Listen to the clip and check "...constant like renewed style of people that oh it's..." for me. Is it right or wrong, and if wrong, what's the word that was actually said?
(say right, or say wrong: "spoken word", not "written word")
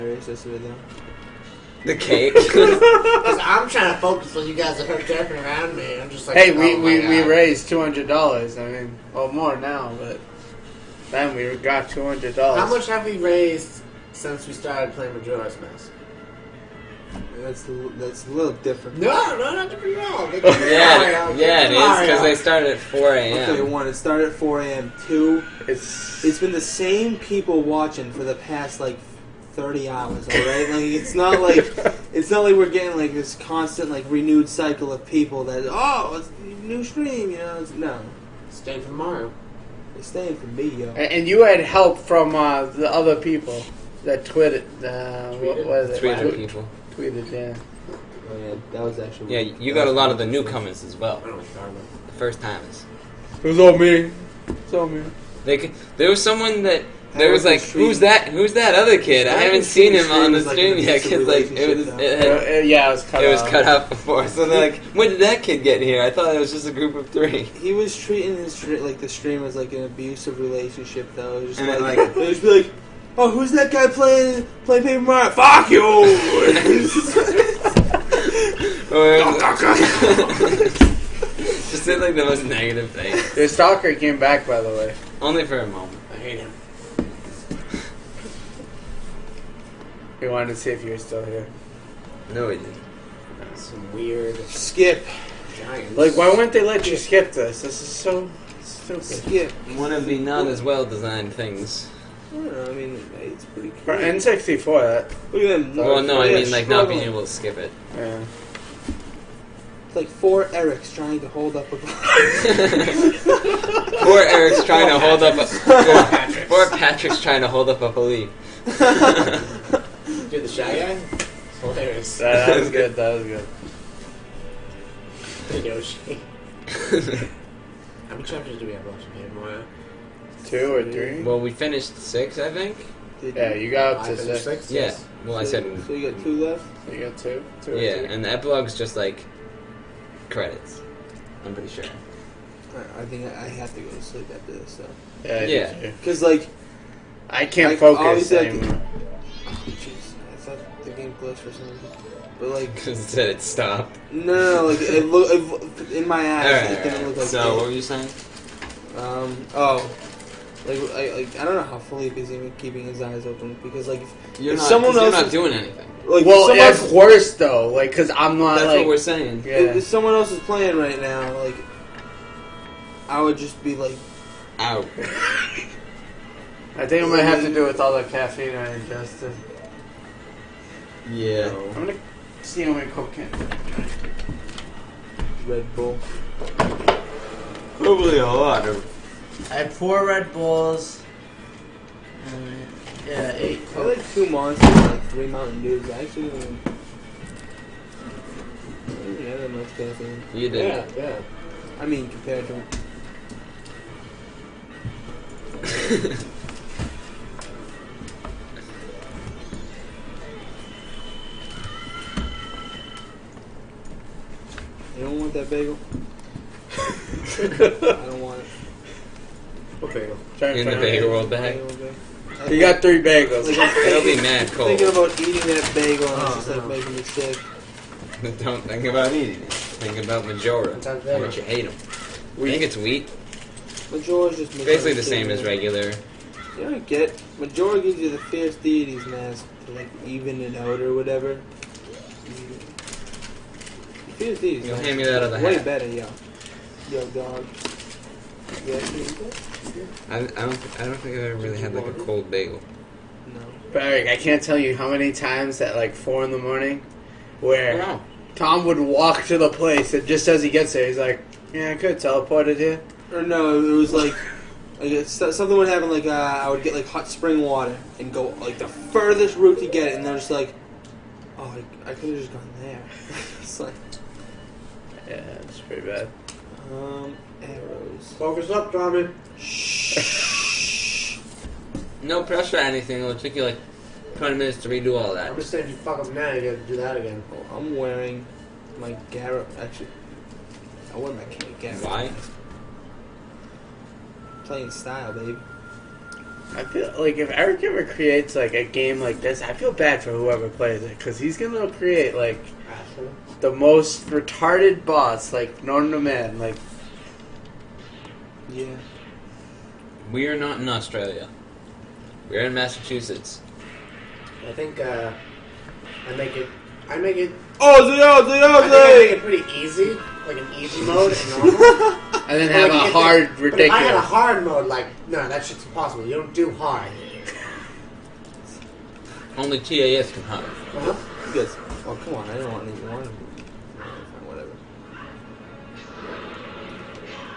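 wrong: "cycle", not "style".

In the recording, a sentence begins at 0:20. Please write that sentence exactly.
yeah, yeah, it is because they started at four a.m.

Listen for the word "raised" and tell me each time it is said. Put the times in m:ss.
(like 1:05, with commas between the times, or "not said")
0:07, 0:13.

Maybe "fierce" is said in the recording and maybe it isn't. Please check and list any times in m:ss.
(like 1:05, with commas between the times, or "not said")
3:58, 4:04.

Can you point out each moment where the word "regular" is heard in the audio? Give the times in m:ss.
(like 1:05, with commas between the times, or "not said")
3:55.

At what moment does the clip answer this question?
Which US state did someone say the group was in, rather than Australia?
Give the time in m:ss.
5:12.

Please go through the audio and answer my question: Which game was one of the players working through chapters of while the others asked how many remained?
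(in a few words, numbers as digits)
Paper Mario.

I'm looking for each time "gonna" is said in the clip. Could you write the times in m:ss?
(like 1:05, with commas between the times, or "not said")
3:01, 5:01.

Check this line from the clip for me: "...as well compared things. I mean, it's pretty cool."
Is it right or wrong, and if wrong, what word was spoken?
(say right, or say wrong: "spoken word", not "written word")
wrong: "designed", not "compared".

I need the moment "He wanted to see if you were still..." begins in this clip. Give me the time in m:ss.
1:30.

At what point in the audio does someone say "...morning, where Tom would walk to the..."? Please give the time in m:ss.
4:16.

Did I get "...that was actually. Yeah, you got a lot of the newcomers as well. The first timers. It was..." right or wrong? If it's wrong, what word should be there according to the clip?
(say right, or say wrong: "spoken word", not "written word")
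right.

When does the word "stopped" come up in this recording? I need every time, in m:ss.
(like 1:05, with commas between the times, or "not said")
2:33.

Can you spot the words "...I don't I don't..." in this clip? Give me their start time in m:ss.
4:10.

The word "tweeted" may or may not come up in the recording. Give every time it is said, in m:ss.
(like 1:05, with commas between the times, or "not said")
0:44.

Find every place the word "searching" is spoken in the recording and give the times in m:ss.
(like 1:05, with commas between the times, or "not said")
not said.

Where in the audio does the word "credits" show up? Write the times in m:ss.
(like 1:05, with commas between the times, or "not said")
2:20.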